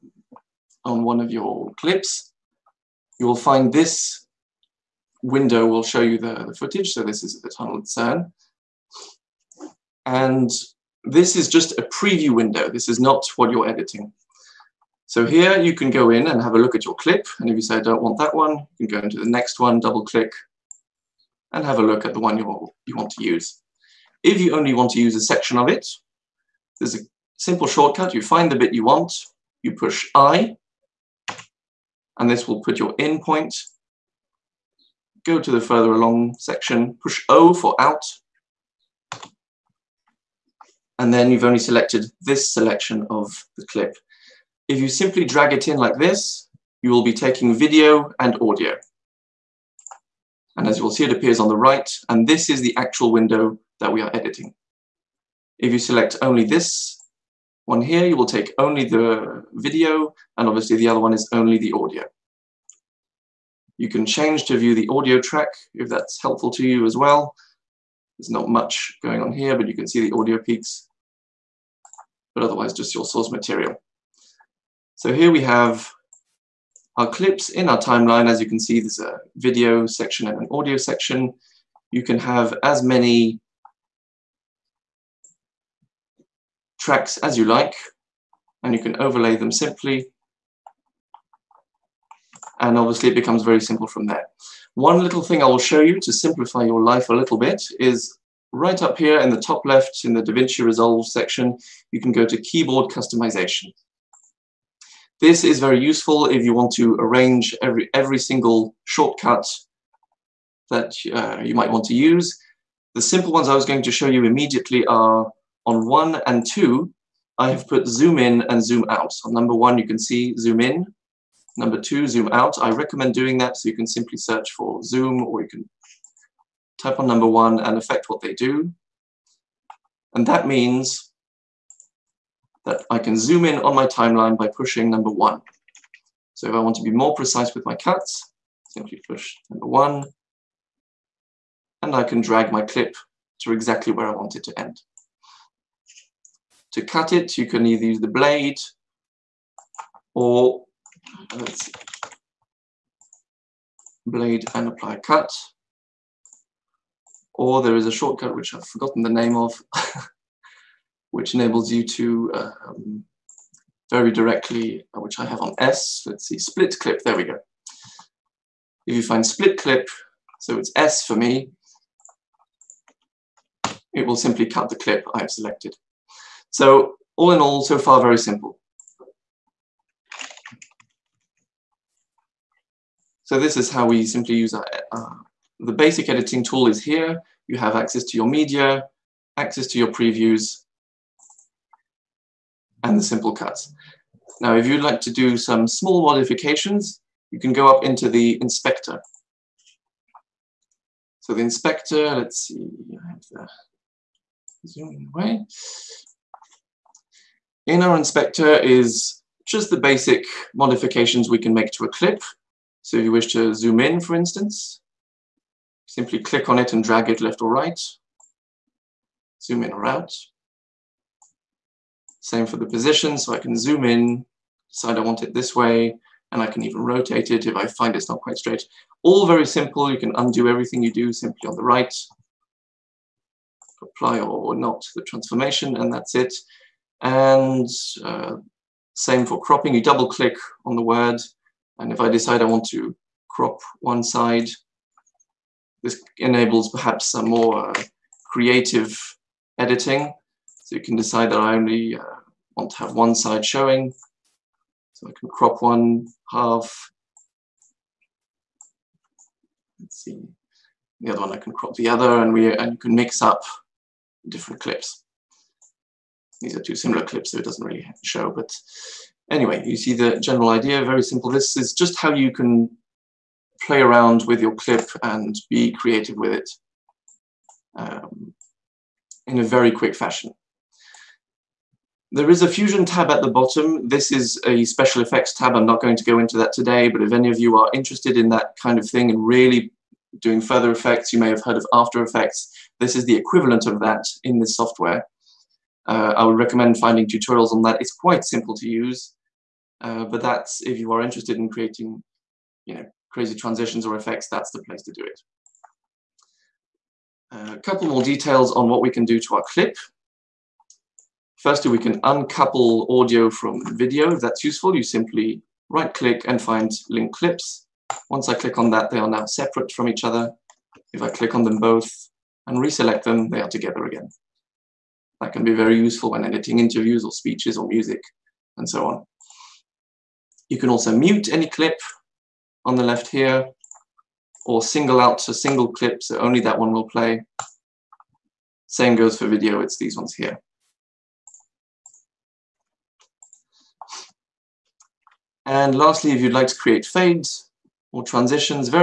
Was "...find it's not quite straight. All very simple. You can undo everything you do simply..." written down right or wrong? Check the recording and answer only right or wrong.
right.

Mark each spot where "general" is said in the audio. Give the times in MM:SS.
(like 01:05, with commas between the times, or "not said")
04:30.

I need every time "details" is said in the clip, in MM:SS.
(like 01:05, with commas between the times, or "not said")
05:08.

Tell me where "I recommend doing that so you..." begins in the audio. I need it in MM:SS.
02:02.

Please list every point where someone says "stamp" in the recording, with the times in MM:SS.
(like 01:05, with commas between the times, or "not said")
not said.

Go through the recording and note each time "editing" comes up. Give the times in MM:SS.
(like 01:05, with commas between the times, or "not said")
00:13, 00:54, 03:06, 04:09, 05:26.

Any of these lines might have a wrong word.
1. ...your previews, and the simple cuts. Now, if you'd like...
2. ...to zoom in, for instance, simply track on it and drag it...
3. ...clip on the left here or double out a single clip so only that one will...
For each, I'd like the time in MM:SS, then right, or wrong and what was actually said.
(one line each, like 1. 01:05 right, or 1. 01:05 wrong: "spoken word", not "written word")
1. 03:09 right
2. 03:33 wrong: "click", not "track"
3. 05:31 wrong: "single", not "double".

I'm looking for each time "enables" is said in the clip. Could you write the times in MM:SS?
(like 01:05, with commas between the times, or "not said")
02:41, 04:06.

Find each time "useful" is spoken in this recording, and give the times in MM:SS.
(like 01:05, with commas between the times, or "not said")
01:45, 05:14, 05:25.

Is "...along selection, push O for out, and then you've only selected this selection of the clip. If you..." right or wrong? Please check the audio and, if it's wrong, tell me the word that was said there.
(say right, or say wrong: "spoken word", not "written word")
wrong: "section", not "selection".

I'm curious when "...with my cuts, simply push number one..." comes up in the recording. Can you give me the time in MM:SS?
02:17.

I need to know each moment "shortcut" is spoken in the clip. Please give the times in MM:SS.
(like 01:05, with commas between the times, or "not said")
00:27, 01:48, 02:37.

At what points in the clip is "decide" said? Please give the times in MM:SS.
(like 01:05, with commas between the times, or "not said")
03:44, 04:02, 04:10.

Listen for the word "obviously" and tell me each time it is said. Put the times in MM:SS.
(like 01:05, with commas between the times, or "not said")
01:00, 01:32.